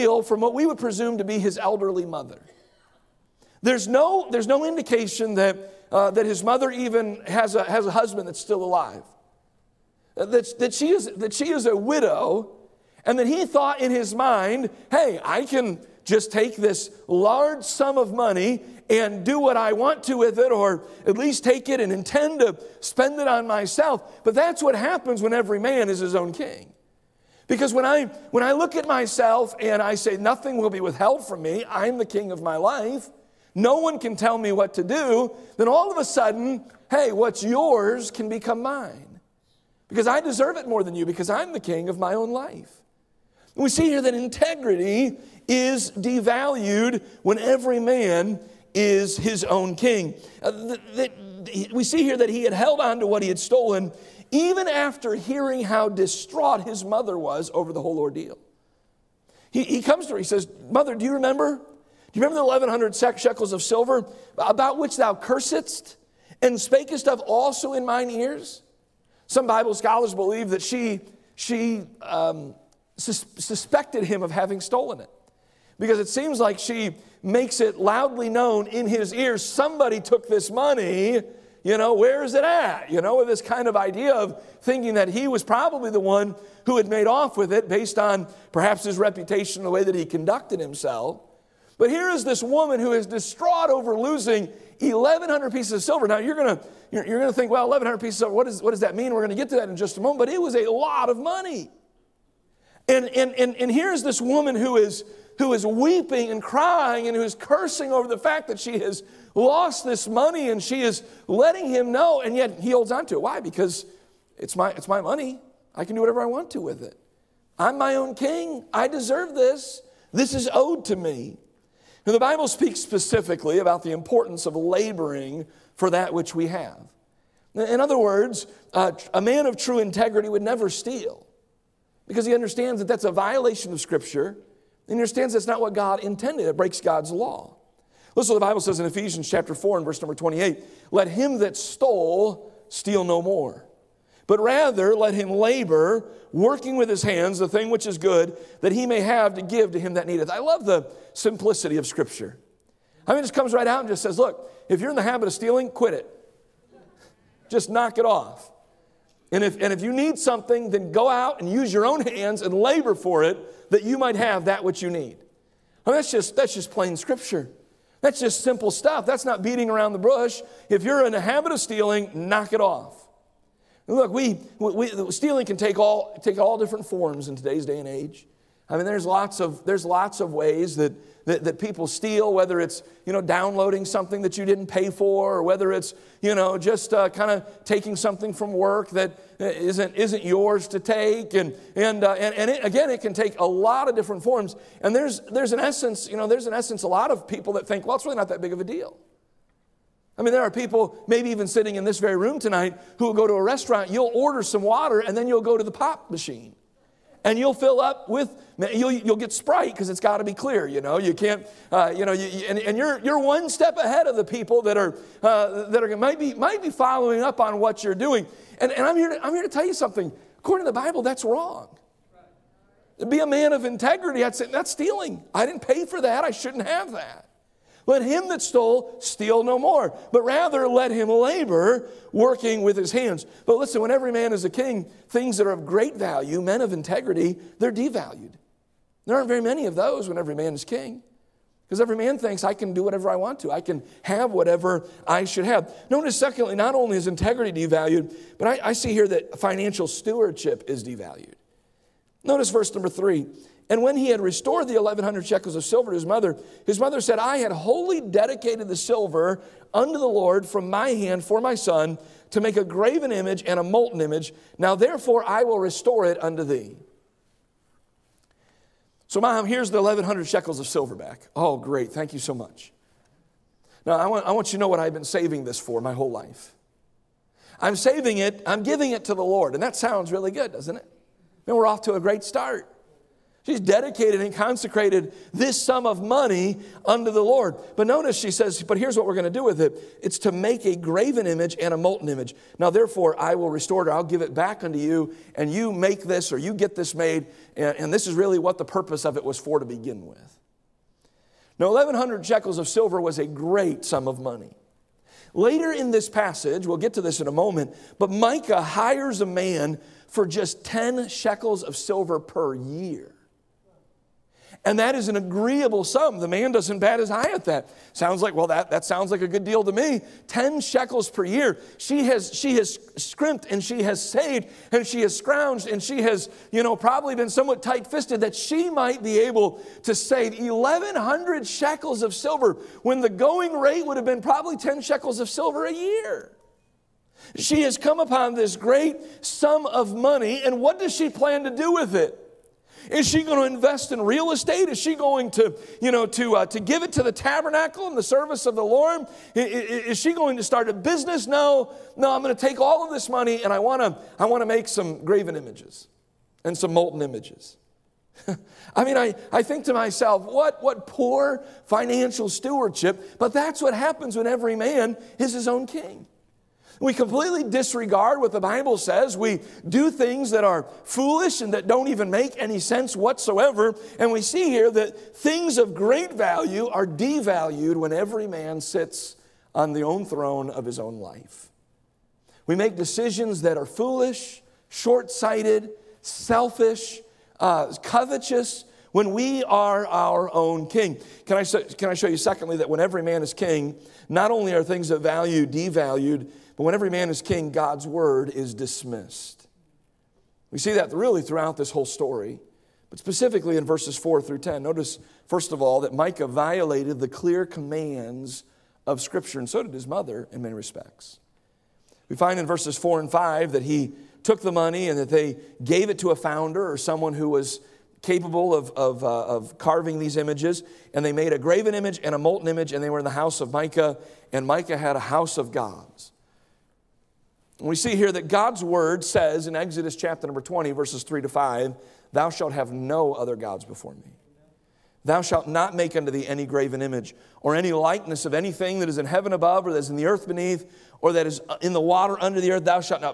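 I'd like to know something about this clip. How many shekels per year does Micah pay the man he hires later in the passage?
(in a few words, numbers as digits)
10.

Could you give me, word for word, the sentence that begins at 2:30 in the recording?
I love the simplicity of Scripture.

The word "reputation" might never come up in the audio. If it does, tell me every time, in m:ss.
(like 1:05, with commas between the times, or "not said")
1:28.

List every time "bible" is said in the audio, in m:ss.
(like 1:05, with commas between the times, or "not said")
1:09, 2:02, 2:18, 3:40, 6:08.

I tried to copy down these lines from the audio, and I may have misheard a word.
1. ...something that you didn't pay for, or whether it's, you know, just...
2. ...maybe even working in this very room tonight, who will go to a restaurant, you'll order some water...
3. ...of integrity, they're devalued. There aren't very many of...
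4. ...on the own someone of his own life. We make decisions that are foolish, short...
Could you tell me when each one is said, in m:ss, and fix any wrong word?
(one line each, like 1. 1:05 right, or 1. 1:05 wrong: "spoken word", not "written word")
1. 3:03 right
2. 3:21 wrong: "sitting", not "working"
3. 3:56 right
4. 6:19 wrong: "throne", not "someone".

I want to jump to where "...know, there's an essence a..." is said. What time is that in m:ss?
3:16.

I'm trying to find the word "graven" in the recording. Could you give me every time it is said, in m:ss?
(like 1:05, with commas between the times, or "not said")
4:22, 4:50, 5:55, 7:01, 7:16.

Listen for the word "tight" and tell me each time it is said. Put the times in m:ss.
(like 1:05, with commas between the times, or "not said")
5:27.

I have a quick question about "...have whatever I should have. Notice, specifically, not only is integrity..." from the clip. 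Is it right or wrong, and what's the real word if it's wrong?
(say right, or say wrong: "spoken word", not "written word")
wrong: "secondly", not "specifically".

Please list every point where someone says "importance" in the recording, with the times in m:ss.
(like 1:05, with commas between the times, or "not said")
2:03.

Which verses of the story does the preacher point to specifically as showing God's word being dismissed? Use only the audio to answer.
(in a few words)
4 through 10.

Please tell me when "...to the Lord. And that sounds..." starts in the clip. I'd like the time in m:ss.
4:39.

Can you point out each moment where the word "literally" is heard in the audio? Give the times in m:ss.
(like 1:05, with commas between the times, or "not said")
not said.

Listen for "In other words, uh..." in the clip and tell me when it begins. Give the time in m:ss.
2:07.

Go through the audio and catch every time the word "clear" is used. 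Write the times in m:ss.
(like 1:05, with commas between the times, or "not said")
3:30, 6:47.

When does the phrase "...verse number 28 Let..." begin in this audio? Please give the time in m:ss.
2:19.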